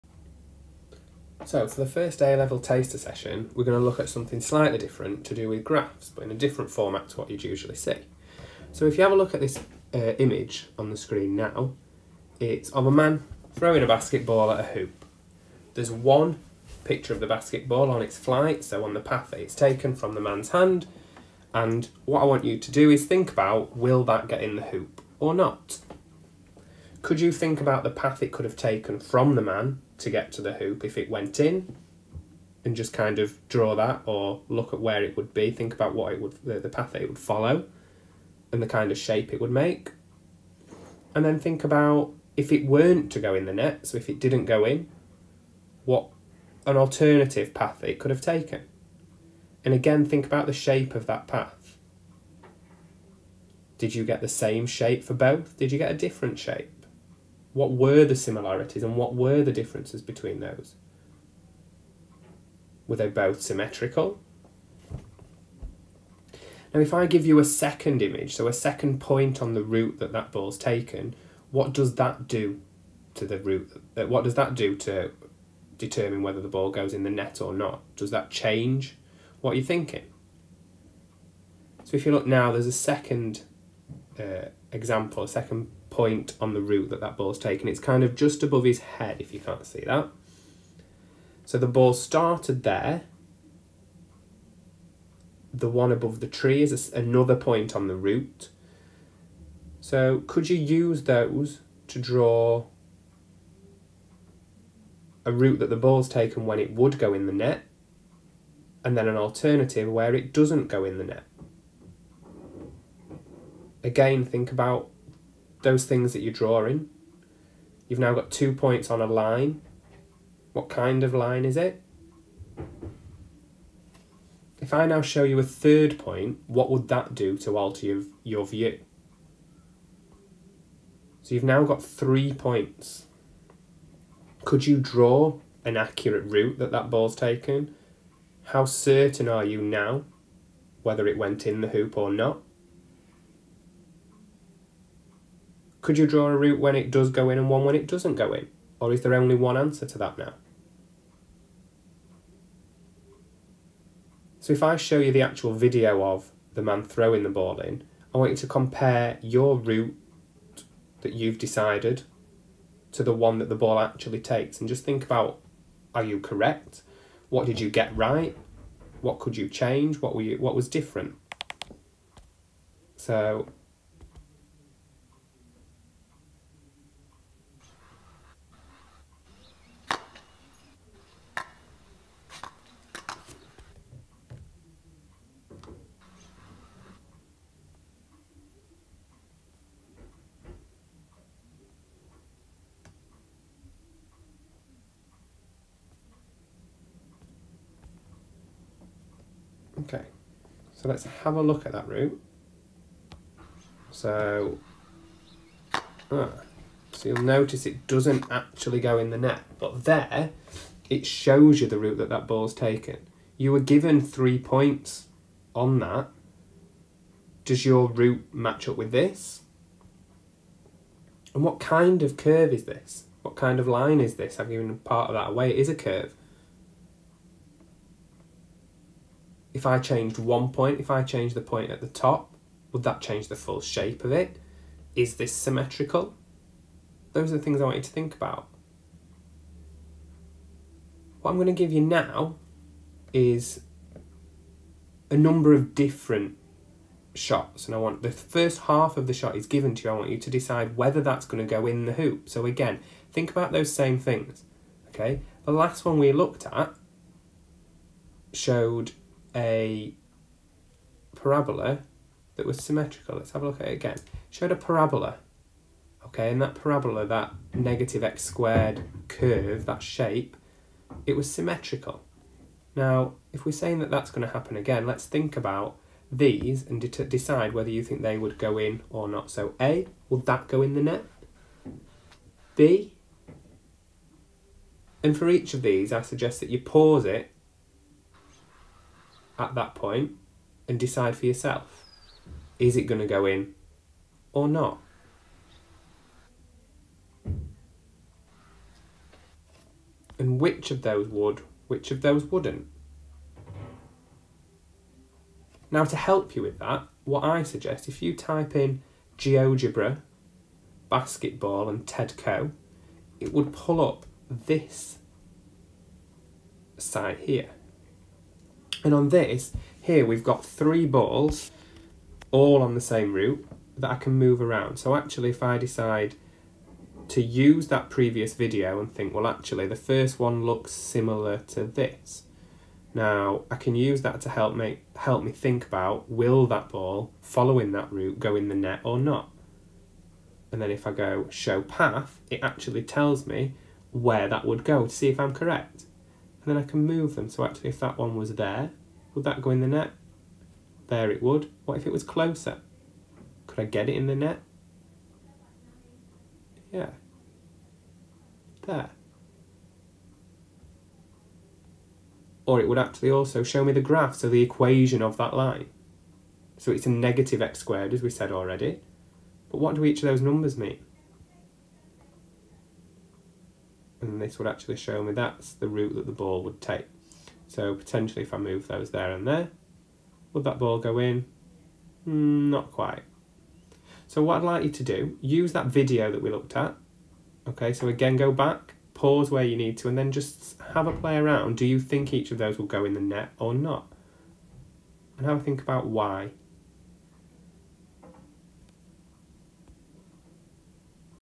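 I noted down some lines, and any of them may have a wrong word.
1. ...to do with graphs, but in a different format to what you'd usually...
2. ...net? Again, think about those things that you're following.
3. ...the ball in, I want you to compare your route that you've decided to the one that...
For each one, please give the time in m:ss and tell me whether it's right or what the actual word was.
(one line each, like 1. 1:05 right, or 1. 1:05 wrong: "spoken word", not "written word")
1. 0:05 right
2. 1:51 wrong: "drawing", not "following"
3. 2:37 right.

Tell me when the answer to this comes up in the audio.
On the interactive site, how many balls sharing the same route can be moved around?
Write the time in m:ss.
5:20.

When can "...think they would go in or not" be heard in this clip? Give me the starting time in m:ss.
4:37.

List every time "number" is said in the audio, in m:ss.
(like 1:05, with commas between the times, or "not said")
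4:05, 6:10.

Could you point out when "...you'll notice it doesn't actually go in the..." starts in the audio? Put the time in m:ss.
3:27.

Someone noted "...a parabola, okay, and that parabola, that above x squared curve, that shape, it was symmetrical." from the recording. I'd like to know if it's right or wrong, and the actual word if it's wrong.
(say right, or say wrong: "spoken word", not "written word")
wrong: "negative", not "above".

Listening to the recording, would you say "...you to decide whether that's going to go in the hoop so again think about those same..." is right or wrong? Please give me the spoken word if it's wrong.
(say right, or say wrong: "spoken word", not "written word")
right.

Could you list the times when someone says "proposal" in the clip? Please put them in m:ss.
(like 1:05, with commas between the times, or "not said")
not said.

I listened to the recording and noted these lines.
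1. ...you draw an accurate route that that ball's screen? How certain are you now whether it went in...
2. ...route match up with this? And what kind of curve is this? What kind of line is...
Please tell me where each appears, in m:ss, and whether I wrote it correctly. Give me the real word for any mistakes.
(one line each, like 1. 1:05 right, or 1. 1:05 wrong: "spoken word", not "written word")
1. 2:14 wrong: "taken", not "screen"
2. 3:37 right.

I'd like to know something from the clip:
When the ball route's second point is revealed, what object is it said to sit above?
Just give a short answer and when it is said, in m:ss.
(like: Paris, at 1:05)
the tree, at 1:36.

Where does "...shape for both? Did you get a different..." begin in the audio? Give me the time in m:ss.
0:54.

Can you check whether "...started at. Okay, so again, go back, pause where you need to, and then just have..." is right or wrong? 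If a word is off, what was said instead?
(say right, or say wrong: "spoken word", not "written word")
wrong: "looked", not "started".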